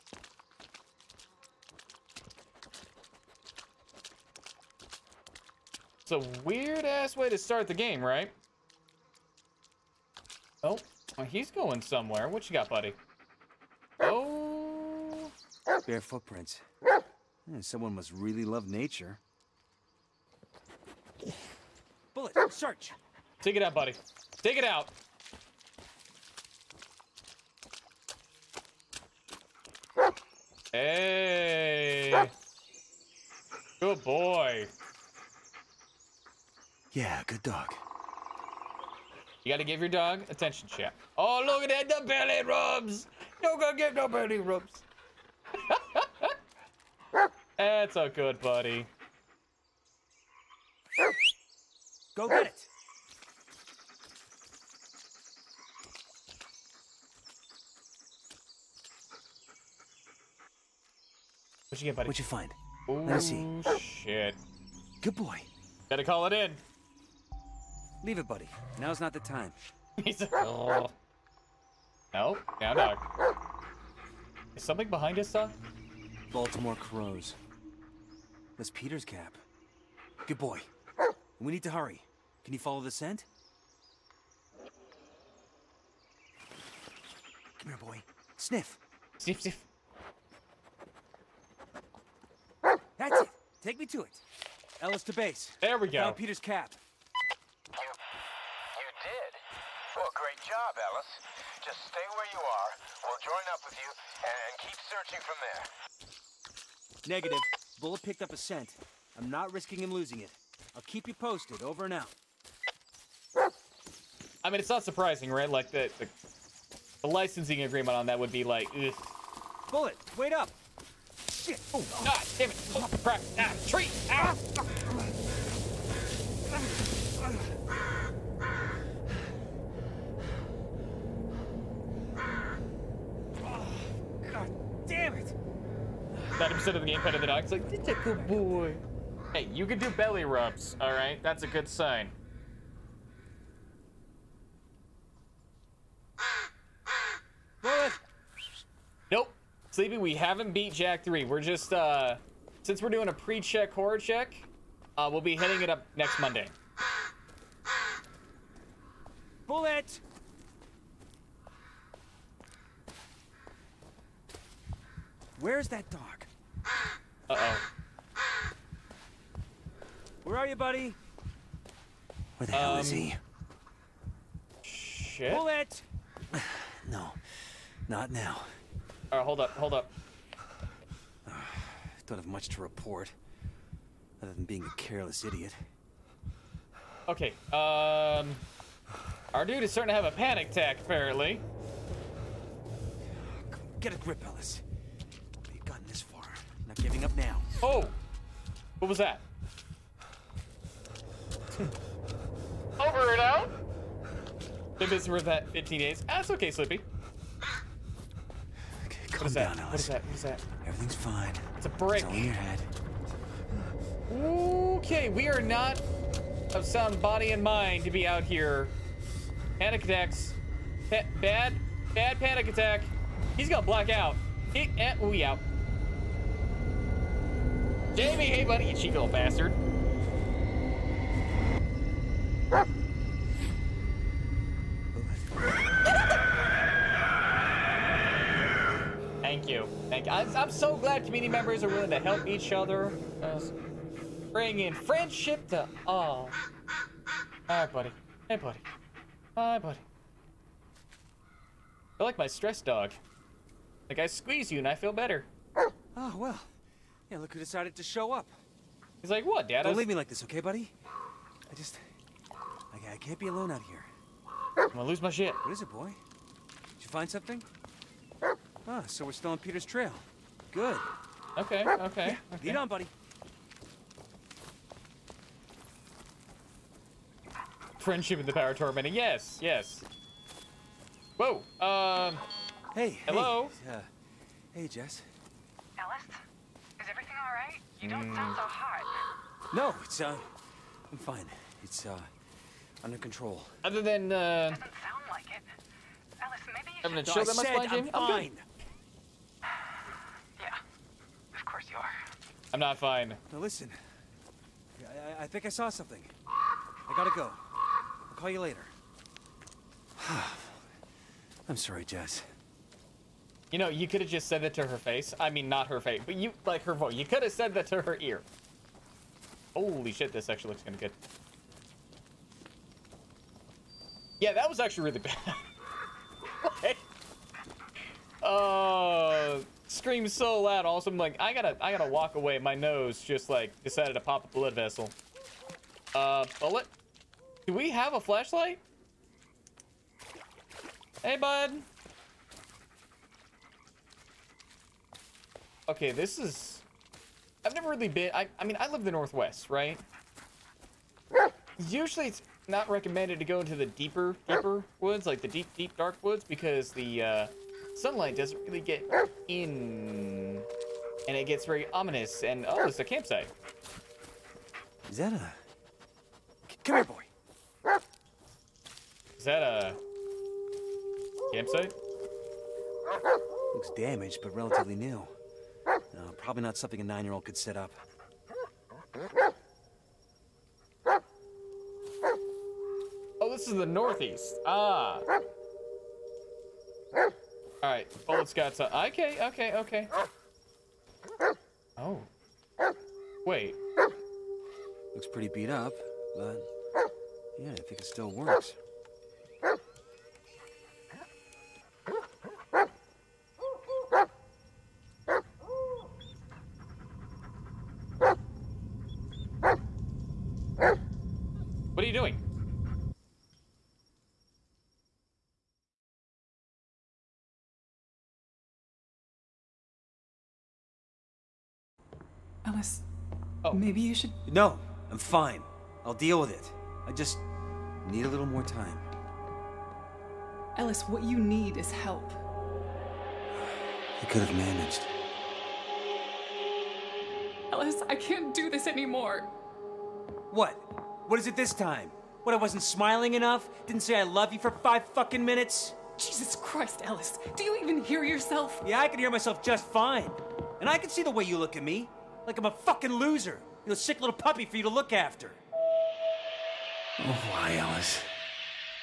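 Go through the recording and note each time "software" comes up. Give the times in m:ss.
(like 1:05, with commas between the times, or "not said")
not said.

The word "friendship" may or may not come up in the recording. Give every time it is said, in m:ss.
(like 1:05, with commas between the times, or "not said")
4:04, 4:37.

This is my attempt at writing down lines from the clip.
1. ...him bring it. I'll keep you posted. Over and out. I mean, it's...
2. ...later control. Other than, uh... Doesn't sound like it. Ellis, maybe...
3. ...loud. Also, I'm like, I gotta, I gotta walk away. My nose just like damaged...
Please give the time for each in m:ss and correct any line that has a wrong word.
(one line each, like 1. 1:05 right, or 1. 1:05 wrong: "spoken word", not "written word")
1. 1:49 wrong: "losing", not "bring"
2. 4:52 wrong: "under", not "later"
3. 5:30 wrong: "decided", not "damaged".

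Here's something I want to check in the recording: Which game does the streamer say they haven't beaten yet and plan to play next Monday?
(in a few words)
Jack 3.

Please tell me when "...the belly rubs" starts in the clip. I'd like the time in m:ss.
0:42.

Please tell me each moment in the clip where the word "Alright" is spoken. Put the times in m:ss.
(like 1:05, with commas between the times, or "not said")
4:07, 6:27.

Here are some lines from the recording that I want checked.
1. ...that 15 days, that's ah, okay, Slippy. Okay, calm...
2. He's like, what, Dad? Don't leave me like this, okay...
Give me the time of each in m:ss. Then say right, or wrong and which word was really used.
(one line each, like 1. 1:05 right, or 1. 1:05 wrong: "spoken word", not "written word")
1. 3:25 right
2. 4:18 right.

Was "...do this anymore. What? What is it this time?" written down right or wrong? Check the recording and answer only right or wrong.
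right.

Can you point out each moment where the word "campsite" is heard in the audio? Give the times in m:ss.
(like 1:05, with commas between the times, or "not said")
6:02, 6:11.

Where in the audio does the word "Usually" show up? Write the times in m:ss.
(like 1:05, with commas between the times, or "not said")
5:51.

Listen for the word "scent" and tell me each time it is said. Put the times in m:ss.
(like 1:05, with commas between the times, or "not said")
1:22, 1:48.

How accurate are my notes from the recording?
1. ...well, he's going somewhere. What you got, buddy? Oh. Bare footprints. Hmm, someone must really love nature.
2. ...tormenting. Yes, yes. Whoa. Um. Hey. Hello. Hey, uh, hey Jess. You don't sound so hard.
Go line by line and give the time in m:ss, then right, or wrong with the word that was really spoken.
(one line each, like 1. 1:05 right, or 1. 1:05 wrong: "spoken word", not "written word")
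1. 0:11 right
2. 4:38 right.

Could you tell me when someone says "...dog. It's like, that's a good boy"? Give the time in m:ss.
2:17.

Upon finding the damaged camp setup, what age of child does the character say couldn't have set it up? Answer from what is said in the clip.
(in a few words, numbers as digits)
9.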